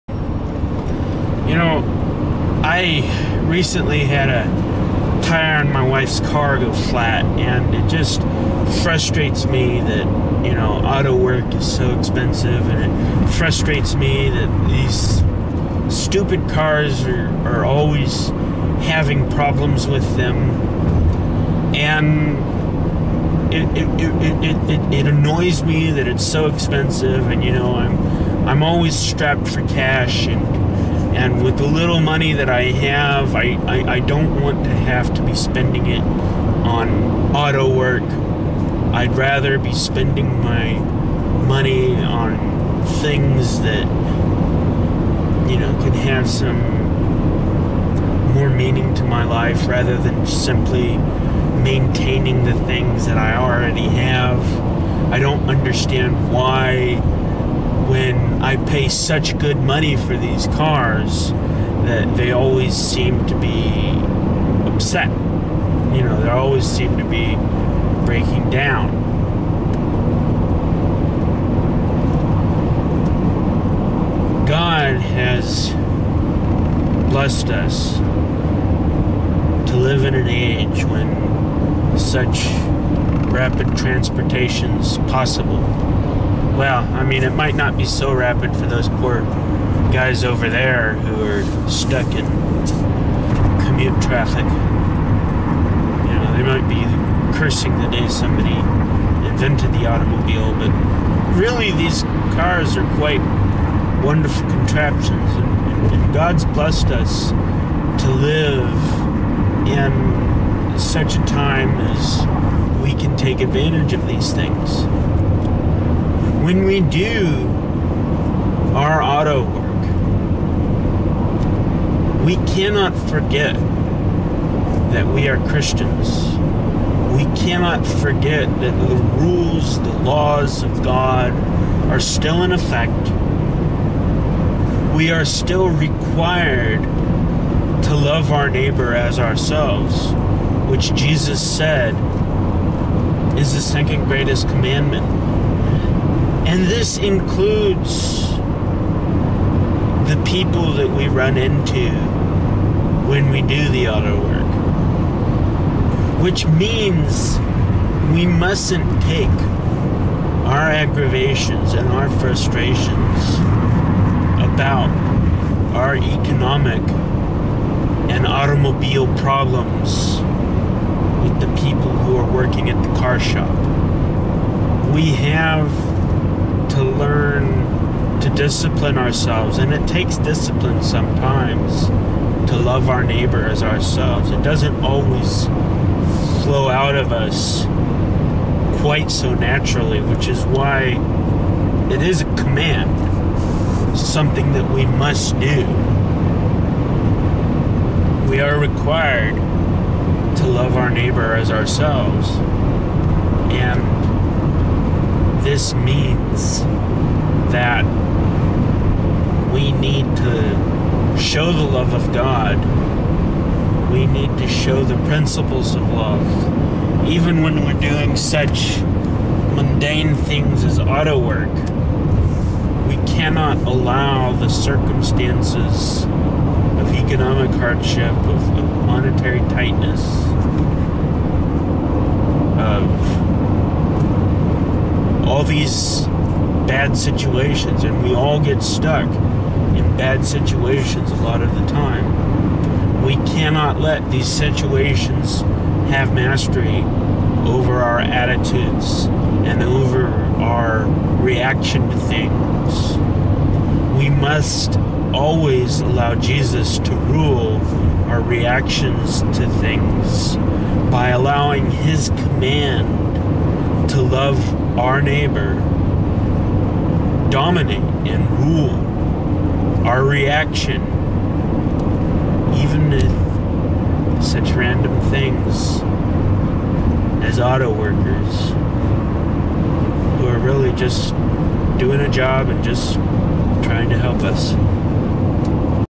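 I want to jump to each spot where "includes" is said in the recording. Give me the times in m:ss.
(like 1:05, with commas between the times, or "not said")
2:26.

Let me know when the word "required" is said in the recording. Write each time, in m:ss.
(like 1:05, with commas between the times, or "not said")
2:15, 3:18.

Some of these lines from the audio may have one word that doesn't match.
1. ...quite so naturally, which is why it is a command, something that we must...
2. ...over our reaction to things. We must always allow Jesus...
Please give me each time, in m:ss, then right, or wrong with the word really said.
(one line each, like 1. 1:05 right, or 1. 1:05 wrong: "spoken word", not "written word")
1. 3:08 right
2. 4:09 right.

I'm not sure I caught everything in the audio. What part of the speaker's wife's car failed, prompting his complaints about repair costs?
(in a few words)
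A tire.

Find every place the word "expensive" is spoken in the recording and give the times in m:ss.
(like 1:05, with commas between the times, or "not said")
0:11, 0:26.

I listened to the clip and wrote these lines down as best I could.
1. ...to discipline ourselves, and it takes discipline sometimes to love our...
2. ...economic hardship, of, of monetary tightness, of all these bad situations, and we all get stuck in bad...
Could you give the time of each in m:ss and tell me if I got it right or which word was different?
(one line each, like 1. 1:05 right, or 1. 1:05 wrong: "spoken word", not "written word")
1. 2:58 right
2. 3:46 right.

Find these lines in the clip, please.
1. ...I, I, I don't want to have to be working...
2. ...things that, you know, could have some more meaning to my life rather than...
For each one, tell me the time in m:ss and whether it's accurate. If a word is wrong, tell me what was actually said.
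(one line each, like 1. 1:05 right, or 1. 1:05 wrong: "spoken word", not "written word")
1. 0:33 wrong: "spending", not "working"
2. 0:42 right.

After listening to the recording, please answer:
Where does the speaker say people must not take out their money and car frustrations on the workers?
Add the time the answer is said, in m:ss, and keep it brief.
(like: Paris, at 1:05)
The car shop, at 2:52.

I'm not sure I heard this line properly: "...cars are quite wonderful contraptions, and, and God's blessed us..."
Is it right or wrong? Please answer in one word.
right.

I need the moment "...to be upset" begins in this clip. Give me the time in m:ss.
1:03.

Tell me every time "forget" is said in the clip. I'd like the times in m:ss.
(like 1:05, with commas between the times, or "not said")
2:03, 2:07.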